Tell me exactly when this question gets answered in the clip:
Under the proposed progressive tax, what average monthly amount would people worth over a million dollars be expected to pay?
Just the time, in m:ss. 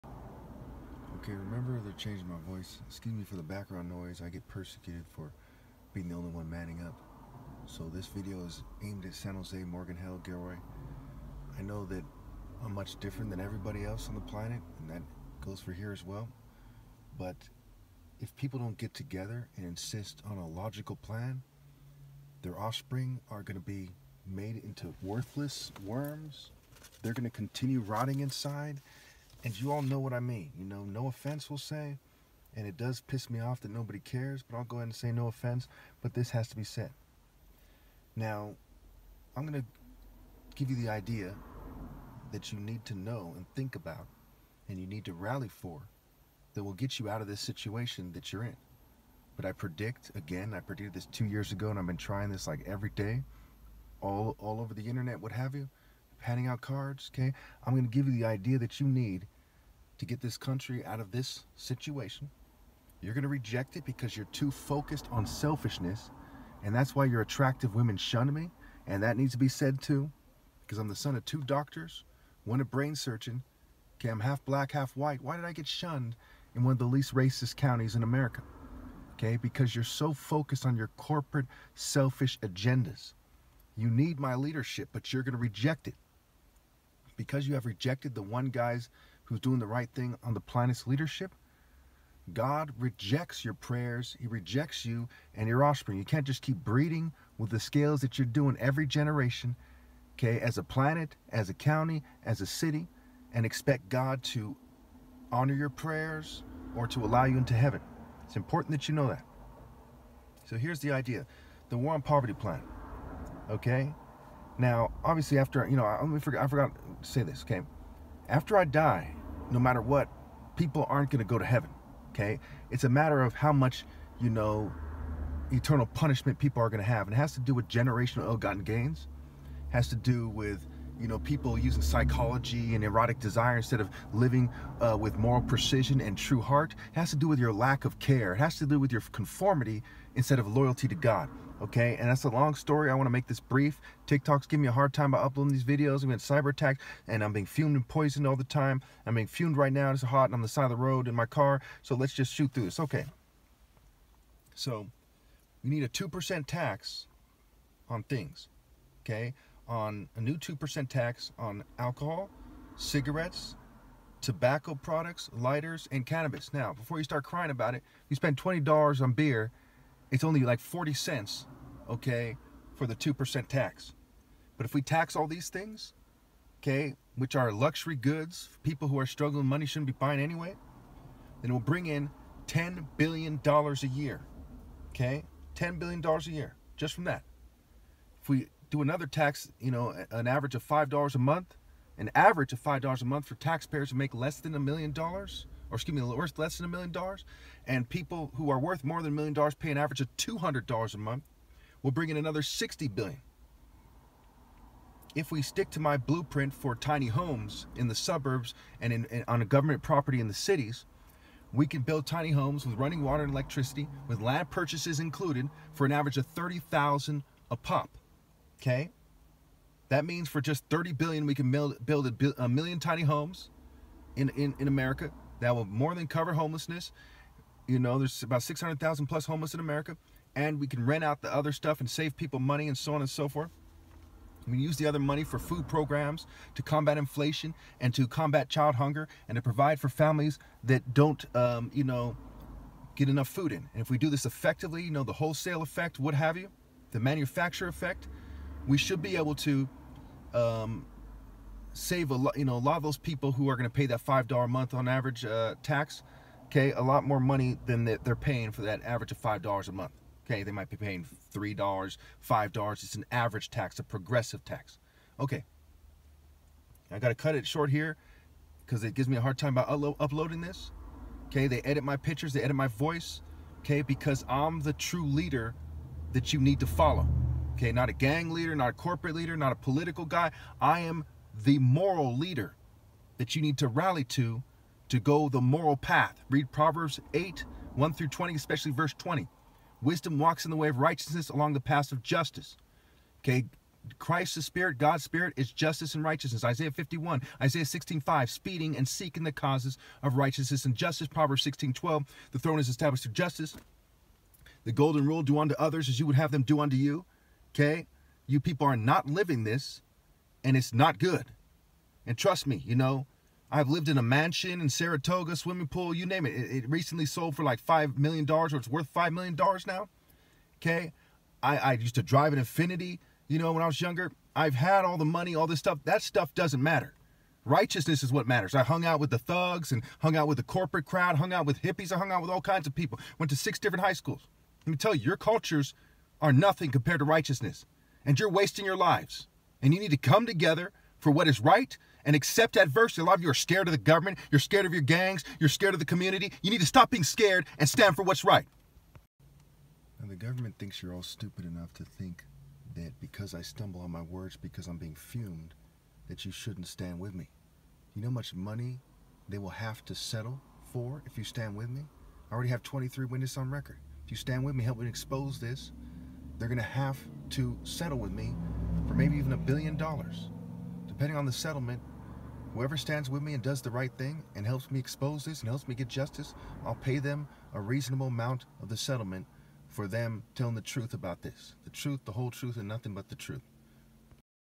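3:20.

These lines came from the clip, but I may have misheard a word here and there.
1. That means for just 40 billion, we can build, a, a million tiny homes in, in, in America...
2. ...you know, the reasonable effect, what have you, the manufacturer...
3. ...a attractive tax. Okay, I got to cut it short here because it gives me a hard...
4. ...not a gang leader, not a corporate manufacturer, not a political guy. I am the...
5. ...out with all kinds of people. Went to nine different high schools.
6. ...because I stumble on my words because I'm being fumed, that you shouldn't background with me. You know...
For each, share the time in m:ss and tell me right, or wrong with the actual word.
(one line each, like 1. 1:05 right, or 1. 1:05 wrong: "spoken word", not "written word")
1. 3:39 wrong: "30", not "40"
2. 4:04 wrong: "wholesale", not "reasonable"
3. 4:23 wrong: "progressive", not "attractive"
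4. 4:37 wrong: "leader", not "manufacturer"
5. 5:32 wrong: "six", not "nine"
6. 5:52 wrong: "stand", not "background".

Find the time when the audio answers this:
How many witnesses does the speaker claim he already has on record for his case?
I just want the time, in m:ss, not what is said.
6:02.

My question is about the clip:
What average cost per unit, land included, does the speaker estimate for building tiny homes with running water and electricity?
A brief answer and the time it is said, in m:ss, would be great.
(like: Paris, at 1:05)
$30,000, at 3:36.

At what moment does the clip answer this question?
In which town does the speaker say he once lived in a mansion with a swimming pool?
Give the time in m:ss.
5:14.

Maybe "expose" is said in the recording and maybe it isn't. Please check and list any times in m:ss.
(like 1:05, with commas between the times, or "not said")
6:04, 6:14.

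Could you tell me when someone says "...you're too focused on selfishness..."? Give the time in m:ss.
1:04.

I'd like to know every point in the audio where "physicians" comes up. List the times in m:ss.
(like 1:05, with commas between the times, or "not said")
not said.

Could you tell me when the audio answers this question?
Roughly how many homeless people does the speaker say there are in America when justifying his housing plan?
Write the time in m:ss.
3:48.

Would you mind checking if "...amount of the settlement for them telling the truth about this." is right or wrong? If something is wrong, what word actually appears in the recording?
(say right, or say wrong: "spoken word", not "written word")
right.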